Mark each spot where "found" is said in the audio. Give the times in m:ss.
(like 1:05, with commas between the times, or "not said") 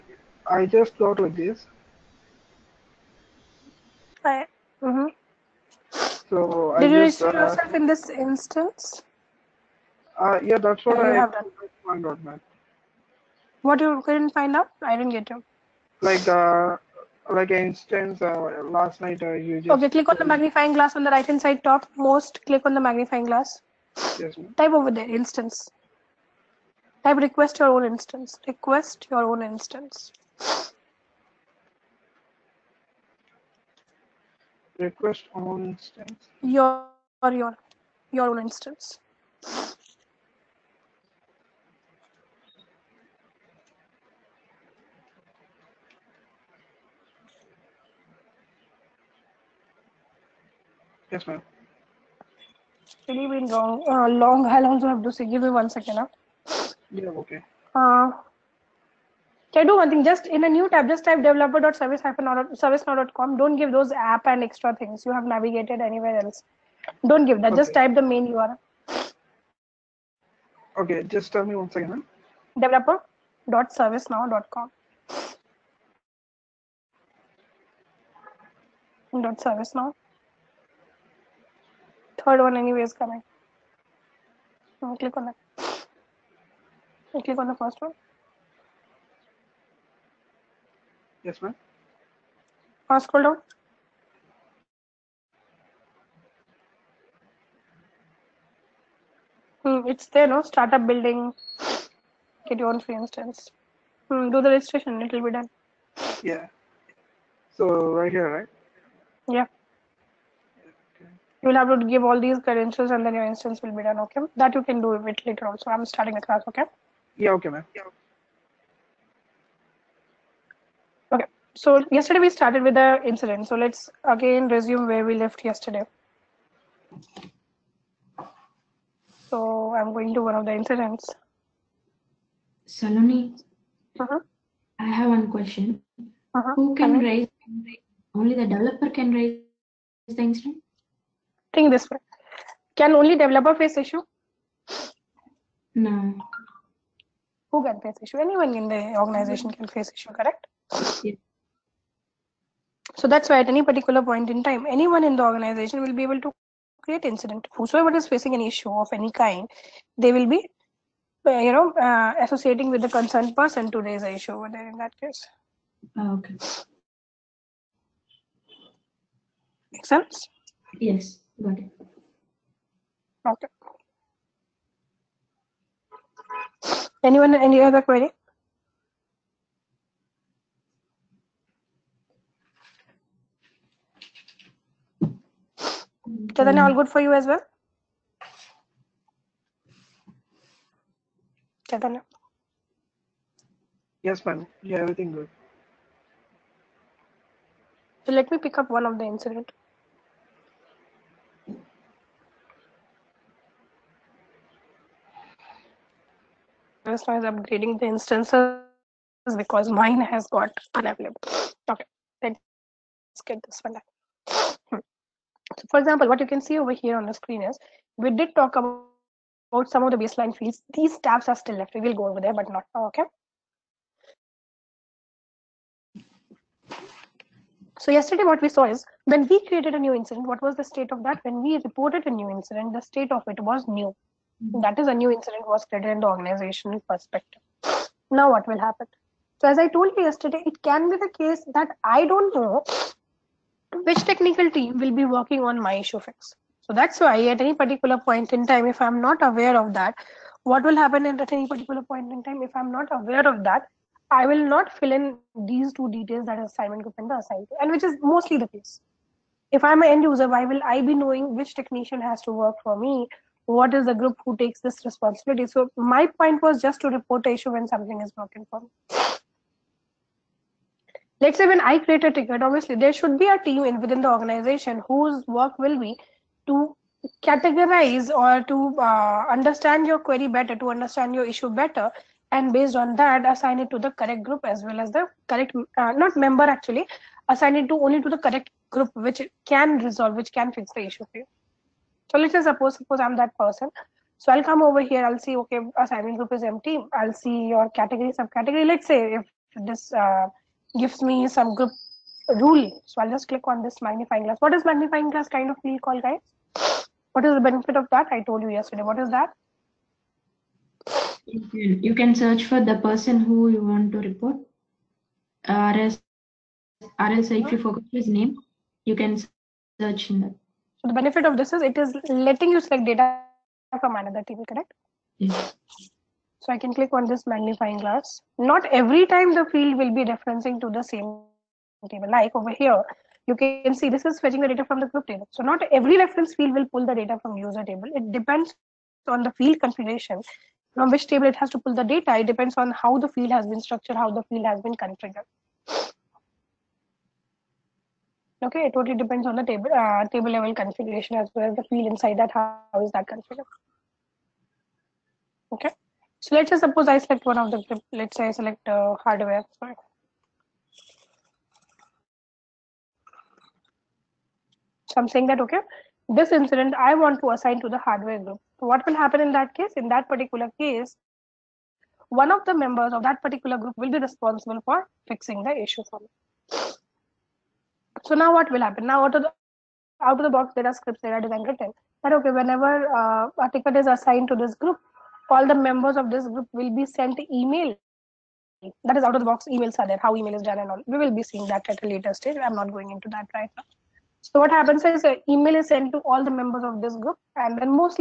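0:11.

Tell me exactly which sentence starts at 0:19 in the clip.
Okay, click on the magnifying glass on the right hand side top most.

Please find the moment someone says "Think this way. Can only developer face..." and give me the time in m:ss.
2:21.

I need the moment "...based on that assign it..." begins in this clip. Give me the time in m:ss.
4:42.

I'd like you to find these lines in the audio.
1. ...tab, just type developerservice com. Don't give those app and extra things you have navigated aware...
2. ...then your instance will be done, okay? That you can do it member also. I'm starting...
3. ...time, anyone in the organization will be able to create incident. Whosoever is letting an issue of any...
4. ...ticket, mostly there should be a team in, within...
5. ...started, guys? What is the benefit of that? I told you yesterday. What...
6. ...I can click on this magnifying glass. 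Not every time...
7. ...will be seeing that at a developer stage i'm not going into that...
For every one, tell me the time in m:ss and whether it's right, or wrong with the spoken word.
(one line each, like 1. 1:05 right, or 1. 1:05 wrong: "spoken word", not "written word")
1. 1:00 wrong: "anywhere", not "aware"
2. 1:53 wrong: "later", not "member"
3. 2:34 wrong: "facing", not "letting"
4. 4:32 wrong: "obviously", not "mostly"
5. 5:05 wrong: "called", not "started"
6. 5:26 right
7. 6:31 wrong: "later", not "developer".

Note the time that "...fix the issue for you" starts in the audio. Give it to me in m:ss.
4:50.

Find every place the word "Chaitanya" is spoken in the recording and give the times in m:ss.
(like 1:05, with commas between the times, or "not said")
3:06, 3:11.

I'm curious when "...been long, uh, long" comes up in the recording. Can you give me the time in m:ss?
0:53.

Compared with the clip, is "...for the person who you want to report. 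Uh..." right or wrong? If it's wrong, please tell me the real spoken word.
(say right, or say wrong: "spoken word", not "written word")
right.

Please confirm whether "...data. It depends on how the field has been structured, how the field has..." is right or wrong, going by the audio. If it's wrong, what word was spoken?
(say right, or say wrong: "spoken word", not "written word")
right.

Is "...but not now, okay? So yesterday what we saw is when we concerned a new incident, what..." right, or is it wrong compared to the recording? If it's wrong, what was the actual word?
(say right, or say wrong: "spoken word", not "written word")
wrong: "created", not "concerned".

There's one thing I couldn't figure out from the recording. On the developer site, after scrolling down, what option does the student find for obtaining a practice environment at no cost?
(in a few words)
Get your own free instance.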